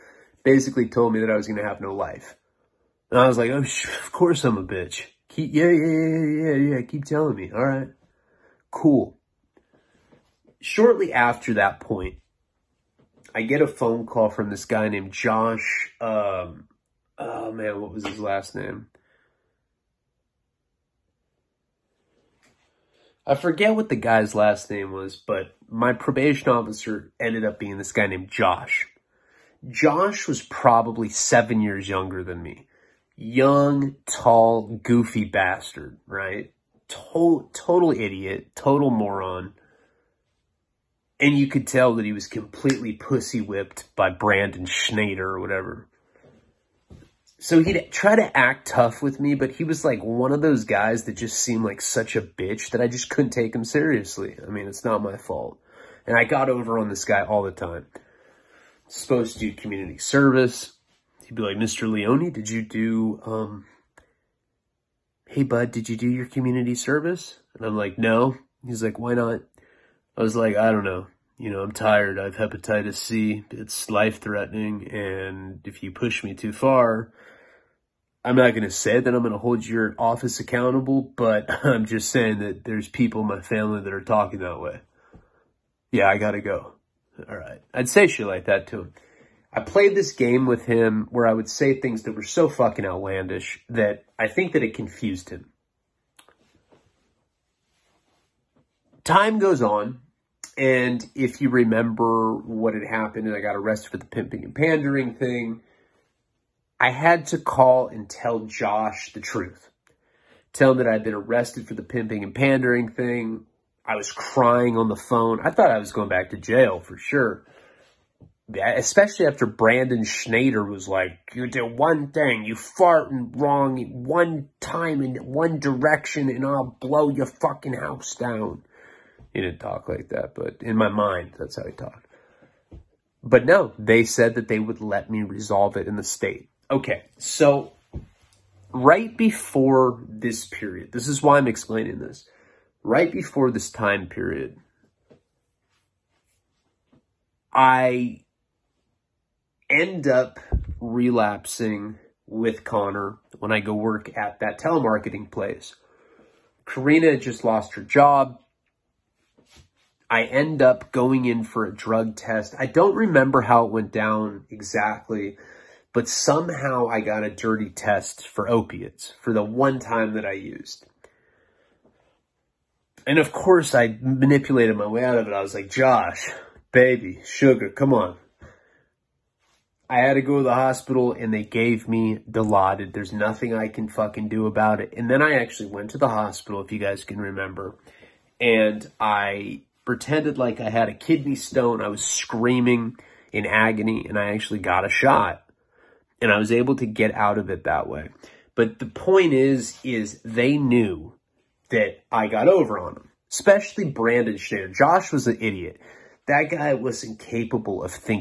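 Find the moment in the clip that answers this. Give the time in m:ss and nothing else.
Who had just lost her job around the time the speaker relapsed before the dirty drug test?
2:36.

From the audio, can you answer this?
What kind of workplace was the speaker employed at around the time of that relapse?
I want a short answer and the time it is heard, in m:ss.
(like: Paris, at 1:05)
telemarketing place, at 2:34.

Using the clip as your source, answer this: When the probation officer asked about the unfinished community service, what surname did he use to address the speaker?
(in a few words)
Leone.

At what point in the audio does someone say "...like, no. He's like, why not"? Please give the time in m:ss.
1:07.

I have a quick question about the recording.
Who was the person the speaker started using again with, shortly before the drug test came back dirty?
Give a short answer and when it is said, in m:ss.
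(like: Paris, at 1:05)
Connor, at 2:32.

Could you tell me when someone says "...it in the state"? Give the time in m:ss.
2:15.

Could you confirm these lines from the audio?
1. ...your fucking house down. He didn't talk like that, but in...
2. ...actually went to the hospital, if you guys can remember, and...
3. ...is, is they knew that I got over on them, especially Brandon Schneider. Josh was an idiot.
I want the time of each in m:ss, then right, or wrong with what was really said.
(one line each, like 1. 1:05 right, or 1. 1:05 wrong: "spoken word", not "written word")
1. 2:07 right
2. 3:05 right
3. 3:19 right.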